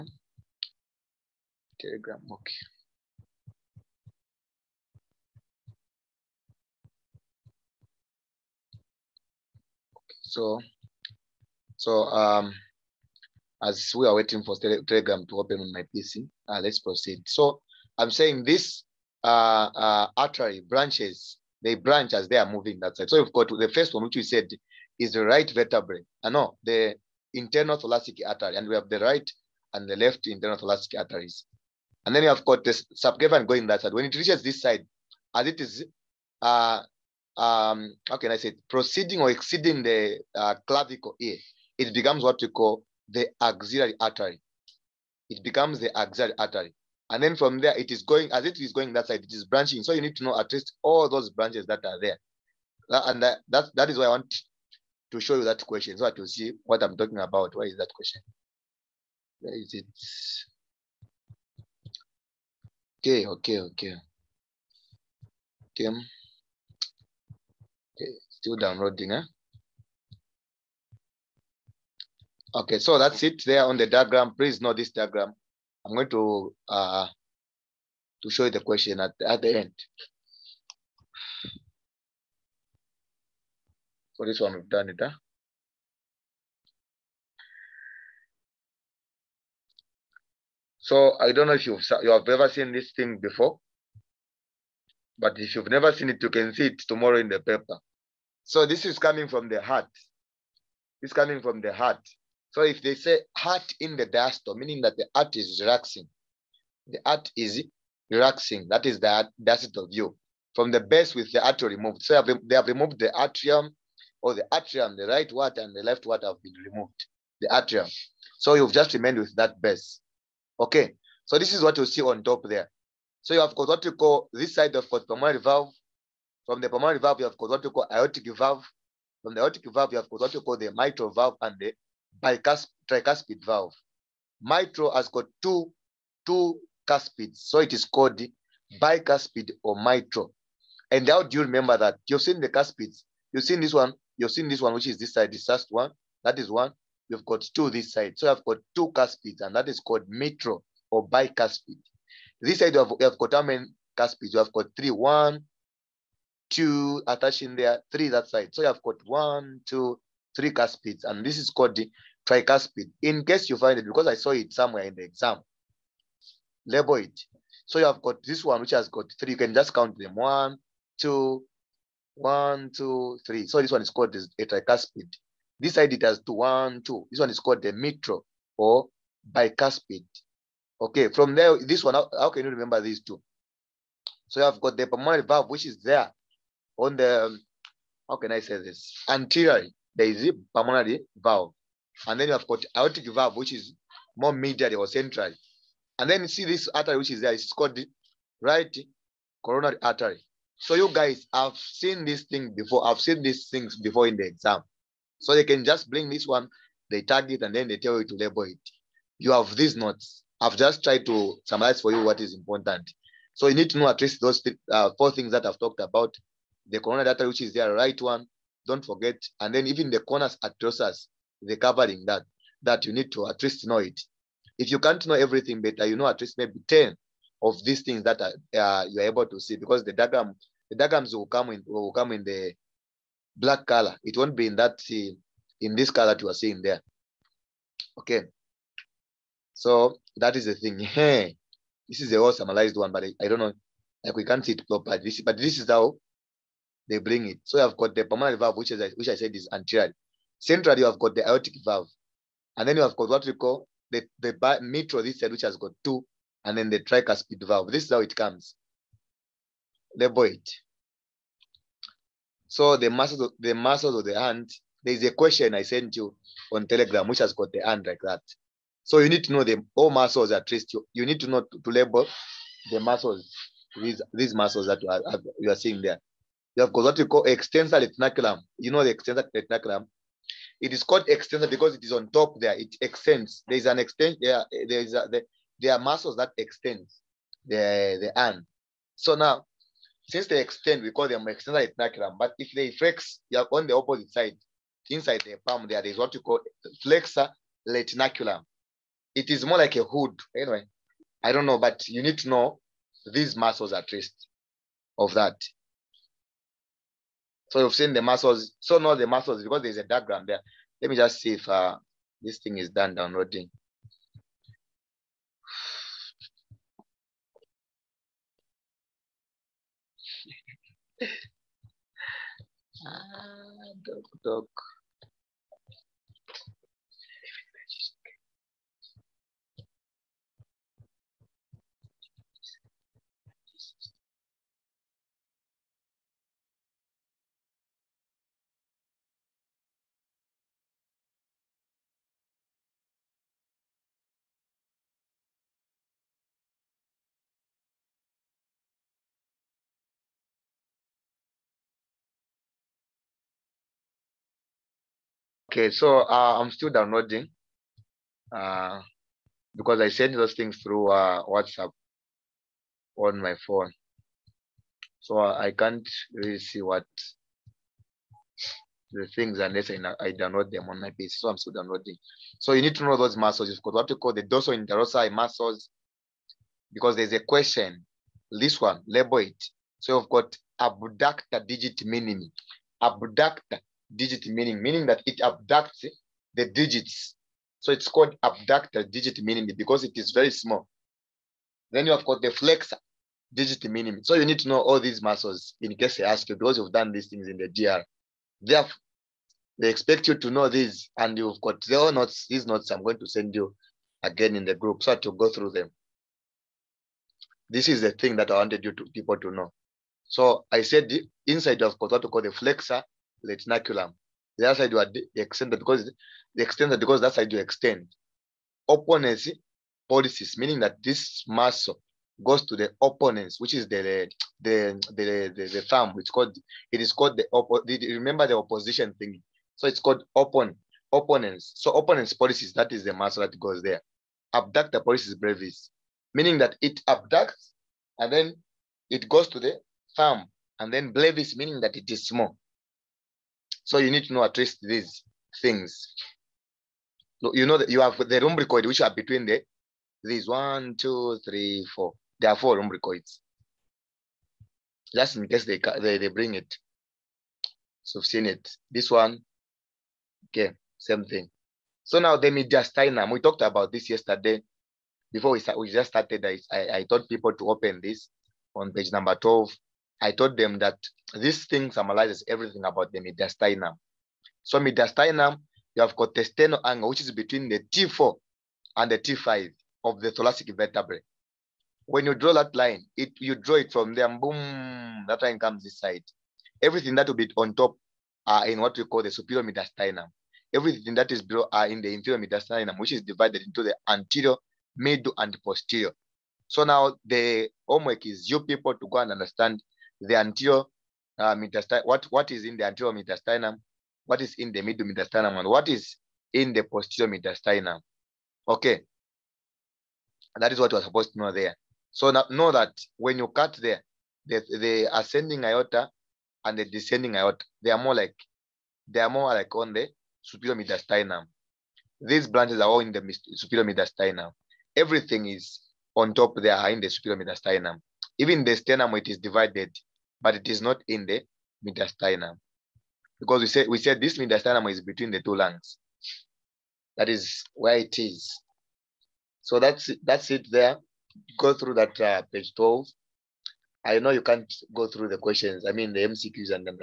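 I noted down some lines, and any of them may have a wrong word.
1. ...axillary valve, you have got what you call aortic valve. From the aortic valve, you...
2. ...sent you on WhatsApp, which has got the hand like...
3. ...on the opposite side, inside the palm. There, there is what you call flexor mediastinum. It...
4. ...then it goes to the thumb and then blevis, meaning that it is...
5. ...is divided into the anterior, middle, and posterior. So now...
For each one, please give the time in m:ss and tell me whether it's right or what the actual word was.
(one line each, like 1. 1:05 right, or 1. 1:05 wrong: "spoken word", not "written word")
1. 2:06 wrong: "pulmonary", not "axillary"
2. 4:25 wrong: "Telegram", not "WhatsApp"
3. 4:53 wrong: "retinaculum", not "mediastinum"
4. 7:18 right
5. 8:12 right.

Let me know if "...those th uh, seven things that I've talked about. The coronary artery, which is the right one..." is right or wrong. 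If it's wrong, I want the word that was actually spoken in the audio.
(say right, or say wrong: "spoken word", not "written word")
wrong: "four", not "seven".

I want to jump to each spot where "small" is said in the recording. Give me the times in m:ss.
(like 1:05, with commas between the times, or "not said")
6:30, 7:22.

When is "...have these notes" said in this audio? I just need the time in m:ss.
3:29.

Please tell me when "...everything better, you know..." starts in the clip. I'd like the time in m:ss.
3:45.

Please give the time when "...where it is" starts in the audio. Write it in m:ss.
8:57.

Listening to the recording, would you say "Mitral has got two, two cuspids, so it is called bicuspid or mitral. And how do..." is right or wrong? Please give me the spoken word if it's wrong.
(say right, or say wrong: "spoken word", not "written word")
right.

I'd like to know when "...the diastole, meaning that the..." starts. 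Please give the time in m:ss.
1:43.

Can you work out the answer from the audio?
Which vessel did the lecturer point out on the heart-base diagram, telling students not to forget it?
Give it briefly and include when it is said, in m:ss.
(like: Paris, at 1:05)
right coronary artery, at 3:18.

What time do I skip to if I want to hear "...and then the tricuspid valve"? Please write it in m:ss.
4:16.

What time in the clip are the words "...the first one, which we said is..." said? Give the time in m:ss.
0:23.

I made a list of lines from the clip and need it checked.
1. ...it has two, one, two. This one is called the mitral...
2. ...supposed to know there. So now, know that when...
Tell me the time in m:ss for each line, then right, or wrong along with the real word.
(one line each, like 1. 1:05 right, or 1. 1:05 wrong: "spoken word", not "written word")
1. 2:55 right
2. 8:30 right.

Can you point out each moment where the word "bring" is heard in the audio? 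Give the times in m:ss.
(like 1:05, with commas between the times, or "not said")
3:25, 4:06, 7:36.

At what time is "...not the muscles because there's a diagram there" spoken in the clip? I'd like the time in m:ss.
5:08.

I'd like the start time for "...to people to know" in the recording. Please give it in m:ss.
6:48.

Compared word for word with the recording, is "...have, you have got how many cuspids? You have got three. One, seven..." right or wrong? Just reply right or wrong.
wrong.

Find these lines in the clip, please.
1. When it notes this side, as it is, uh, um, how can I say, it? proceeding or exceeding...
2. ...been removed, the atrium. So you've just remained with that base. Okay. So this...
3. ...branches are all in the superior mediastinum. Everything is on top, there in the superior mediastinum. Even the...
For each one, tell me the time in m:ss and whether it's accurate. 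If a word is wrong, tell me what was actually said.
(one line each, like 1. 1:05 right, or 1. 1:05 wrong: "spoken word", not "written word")
1. 0:33 wrong: "reaches", not "notes"
2. 1:56 right
3. 8:42 right.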